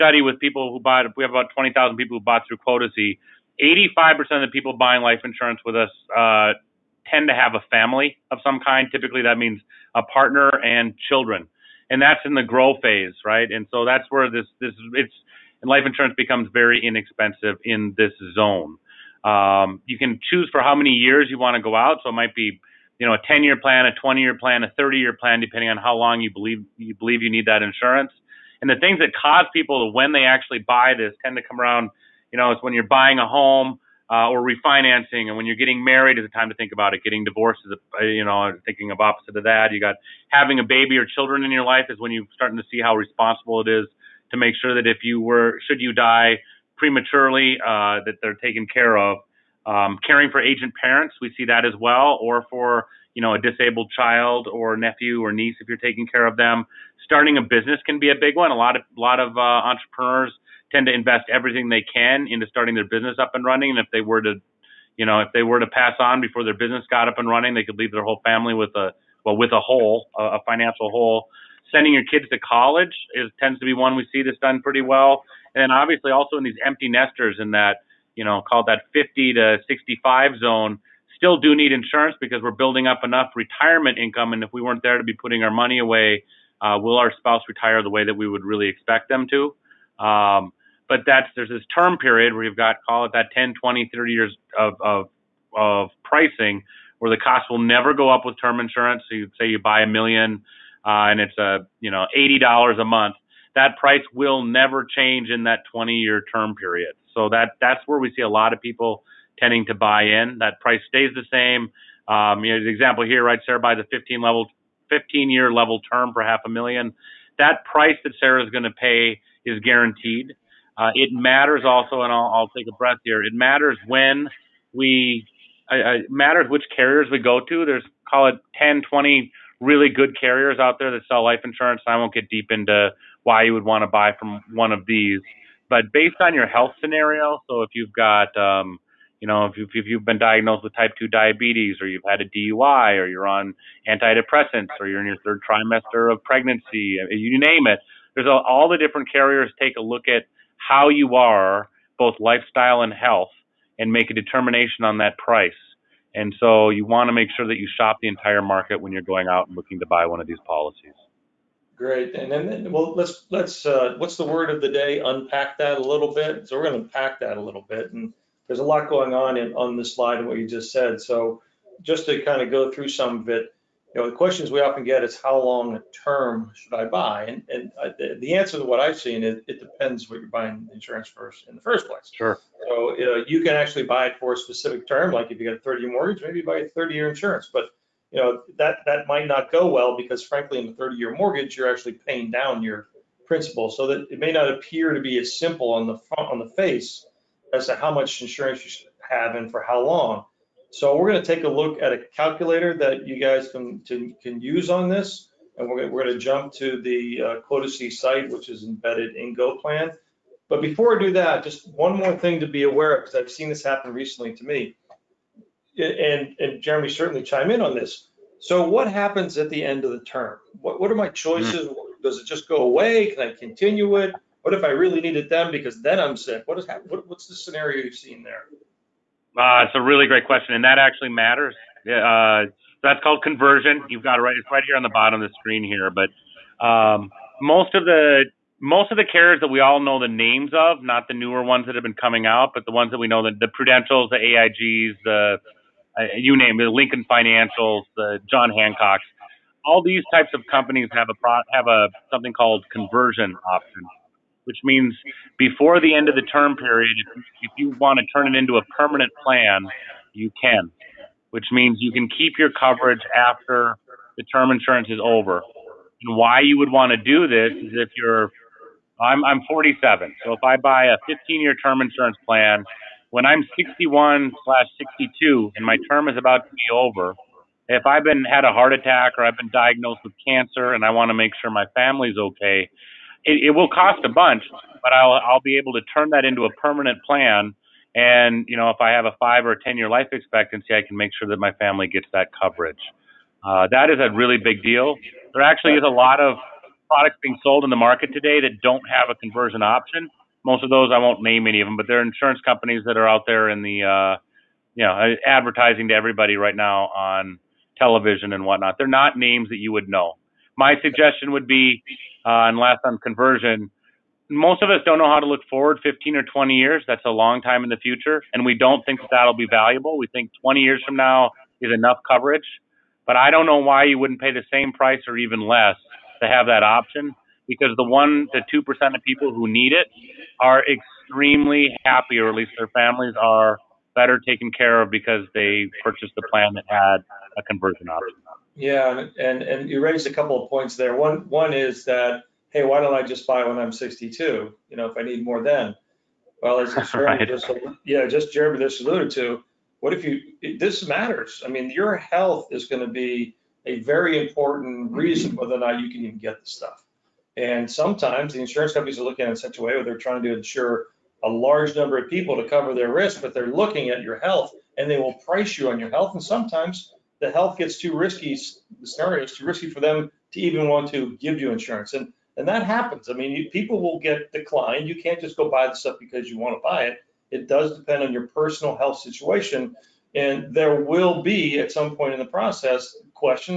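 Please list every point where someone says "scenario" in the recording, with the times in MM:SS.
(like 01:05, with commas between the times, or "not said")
02:16, 03:47, 06:08.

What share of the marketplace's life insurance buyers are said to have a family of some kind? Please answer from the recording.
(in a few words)
85%.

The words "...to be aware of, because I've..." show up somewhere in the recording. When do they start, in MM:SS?
03:32.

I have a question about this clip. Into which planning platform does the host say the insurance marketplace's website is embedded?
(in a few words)
GoPlan.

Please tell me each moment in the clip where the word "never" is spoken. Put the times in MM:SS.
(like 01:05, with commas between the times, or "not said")
01:37, 01:44.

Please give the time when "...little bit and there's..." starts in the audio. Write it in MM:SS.
02:47.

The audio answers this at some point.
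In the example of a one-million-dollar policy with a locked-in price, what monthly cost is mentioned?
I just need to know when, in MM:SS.
01:42.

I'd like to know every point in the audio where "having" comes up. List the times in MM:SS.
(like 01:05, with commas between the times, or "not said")
00:40.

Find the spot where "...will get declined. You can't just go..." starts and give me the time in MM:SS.
06:13.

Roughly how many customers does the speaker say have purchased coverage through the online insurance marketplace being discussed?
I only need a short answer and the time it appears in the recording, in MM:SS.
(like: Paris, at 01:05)
20,000, at 00:01.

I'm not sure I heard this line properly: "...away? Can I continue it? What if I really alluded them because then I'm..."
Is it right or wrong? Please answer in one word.
wrong.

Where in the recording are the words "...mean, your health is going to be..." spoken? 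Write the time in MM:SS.
05:51.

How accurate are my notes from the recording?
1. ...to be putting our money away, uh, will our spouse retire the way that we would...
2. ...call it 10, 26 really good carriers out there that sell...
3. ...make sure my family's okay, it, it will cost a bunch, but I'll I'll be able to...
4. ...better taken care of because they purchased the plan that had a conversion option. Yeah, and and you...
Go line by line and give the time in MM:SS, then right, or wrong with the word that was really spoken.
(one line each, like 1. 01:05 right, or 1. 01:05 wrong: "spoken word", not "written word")
1. 01:24 right
2. 02:08 wrong: "20", not "26"
3. 04:41 right
4. 05:33 right.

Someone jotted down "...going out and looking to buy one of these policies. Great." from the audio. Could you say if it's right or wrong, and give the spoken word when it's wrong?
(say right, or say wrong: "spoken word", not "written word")
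right.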